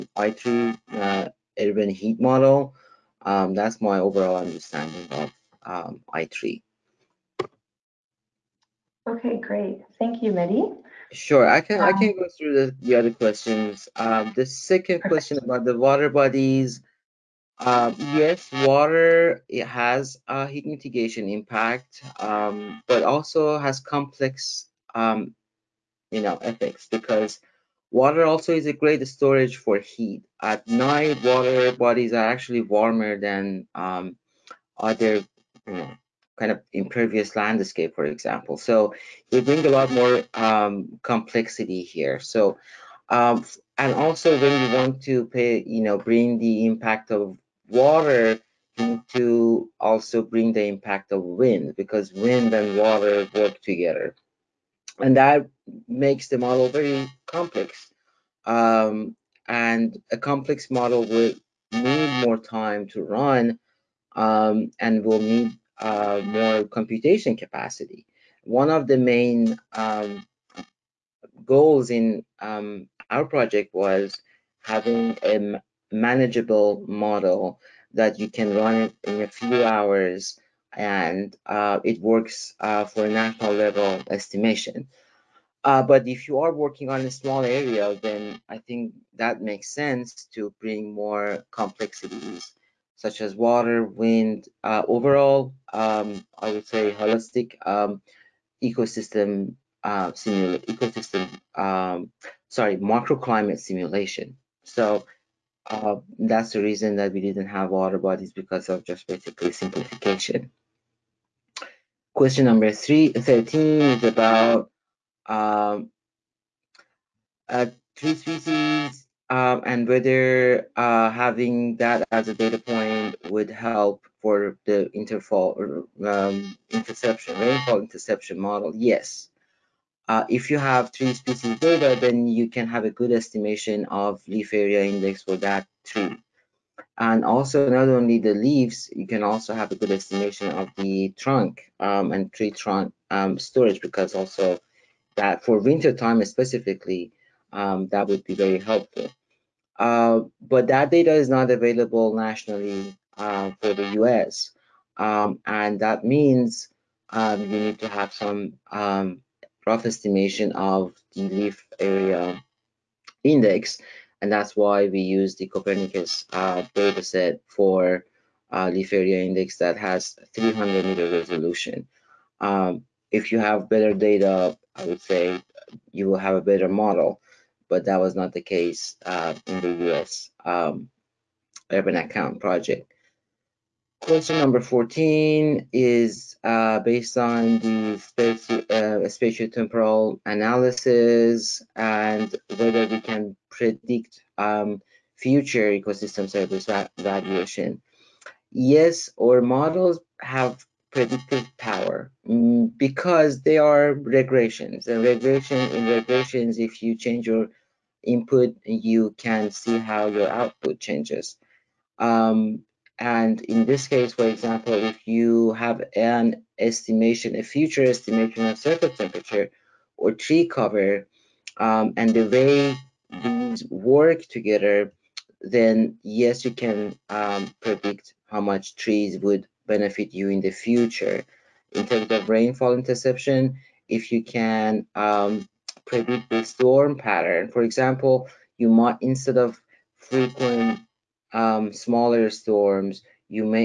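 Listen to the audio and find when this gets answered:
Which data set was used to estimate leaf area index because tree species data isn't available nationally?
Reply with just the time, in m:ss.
2:45.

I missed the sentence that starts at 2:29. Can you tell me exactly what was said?
Uh, but that data is not available nationally uh, for the US.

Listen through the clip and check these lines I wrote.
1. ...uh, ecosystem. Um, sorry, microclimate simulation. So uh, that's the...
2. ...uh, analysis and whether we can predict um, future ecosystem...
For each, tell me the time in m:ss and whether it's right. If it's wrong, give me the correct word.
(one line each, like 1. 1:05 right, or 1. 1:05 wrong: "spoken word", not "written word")
1. 1:39 right
2. 3:10 right.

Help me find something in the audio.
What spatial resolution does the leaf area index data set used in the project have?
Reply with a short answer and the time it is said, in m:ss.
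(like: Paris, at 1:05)
300 meters, at 2:50.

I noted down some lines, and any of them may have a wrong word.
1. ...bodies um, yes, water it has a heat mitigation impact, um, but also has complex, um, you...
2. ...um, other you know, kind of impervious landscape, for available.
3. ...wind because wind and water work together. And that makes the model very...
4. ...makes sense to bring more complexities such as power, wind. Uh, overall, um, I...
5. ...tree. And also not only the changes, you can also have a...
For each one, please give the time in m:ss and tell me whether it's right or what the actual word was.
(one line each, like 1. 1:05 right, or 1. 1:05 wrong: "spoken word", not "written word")
1. 0:16 right
2. 0:33 wrong: "example", not "available"
3. 0:51 right
4. 1:29 wrong: "water", not "power"
5. 2:15 wrong: "leaves", not "changes".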